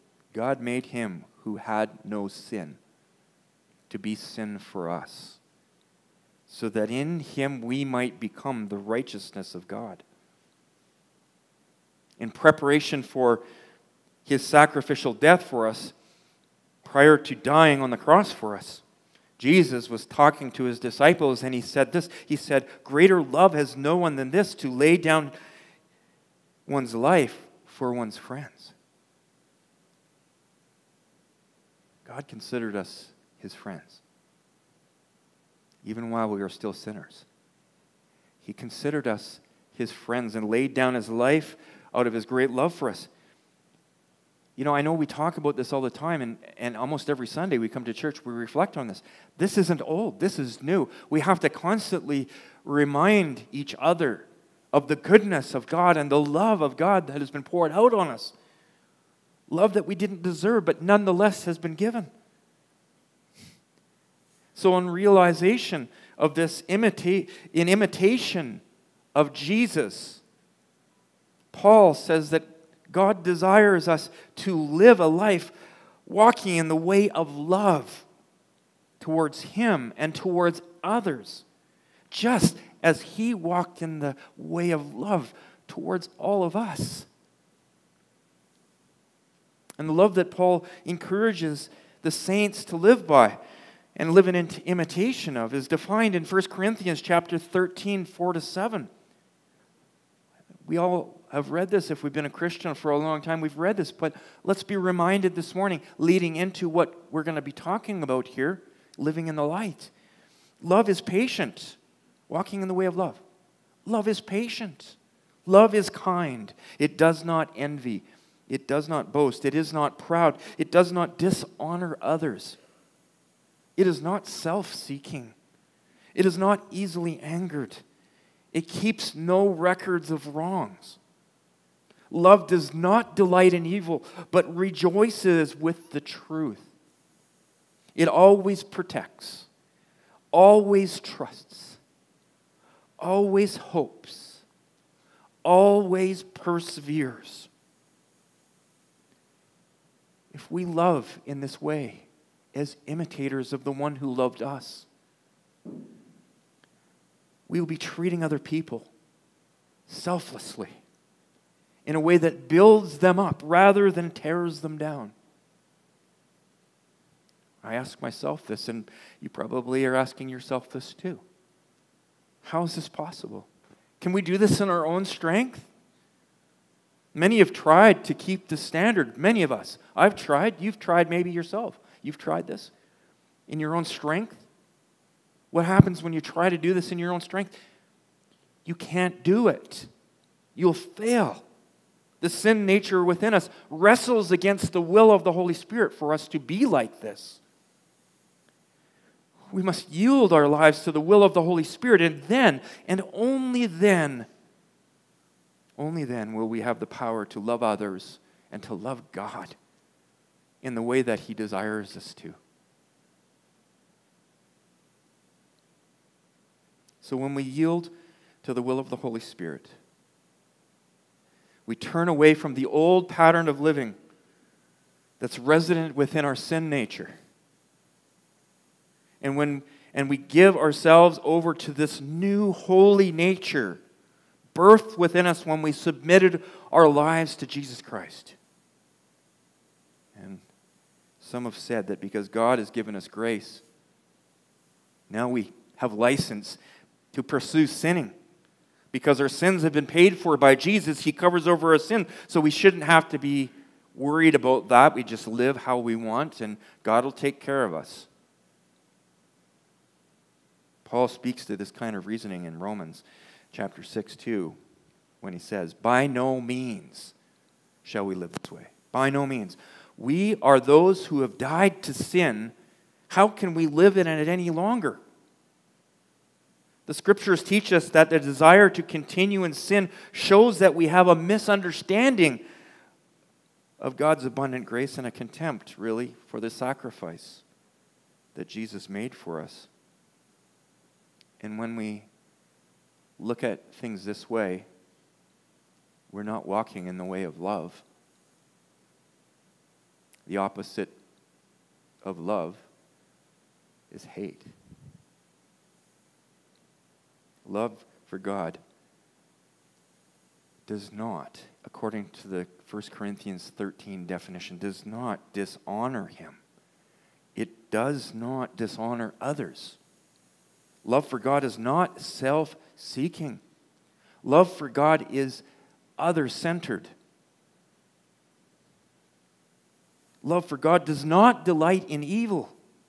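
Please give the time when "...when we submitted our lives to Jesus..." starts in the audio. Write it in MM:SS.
03:55.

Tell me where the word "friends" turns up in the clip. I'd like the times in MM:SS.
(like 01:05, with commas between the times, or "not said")
00:28, 00:33, 00:39.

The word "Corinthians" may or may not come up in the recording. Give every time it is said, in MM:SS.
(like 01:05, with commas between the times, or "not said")
01:36, 05:12.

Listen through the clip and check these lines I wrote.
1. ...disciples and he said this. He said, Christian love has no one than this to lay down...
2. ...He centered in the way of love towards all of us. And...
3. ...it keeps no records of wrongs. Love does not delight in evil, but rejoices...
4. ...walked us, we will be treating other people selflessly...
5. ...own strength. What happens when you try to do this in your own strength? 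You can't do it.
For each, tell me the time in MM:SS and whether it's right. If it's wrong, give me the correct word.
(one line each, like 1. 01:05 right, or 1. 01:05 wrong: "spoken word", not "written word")
1. 00:20 wrong: "Greater", not "Christian"
2. 01:23 wrong: "walked", not "centered"
3. 02:08 right
4. 02:34 wrong: "loved", not "walked"
5. 03:03 right.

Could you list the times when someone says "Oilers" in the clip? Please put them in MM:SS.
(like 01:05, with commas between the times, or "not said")
not said.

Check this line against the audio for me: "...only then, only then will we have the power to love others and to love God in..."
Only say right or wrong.
right.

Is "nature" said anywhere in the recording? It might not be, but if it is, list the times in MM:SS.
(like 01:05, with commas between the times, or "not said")
03:12, 03:46, 03:53.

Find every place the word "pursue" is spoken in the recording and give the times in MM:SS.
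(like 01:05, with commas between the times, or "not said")
04:07.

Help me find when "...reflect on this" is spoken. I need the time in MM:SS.
00:48.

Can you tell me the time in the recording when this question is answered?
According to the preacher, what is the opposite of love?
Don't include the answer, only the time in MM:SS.
05:04.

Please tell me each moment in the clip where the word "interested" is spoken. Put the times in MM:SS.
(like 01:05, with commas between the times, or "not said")
not said.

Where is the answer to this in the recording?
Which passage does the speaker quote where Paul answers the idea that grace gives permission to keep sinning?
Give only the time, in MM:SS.
04:22.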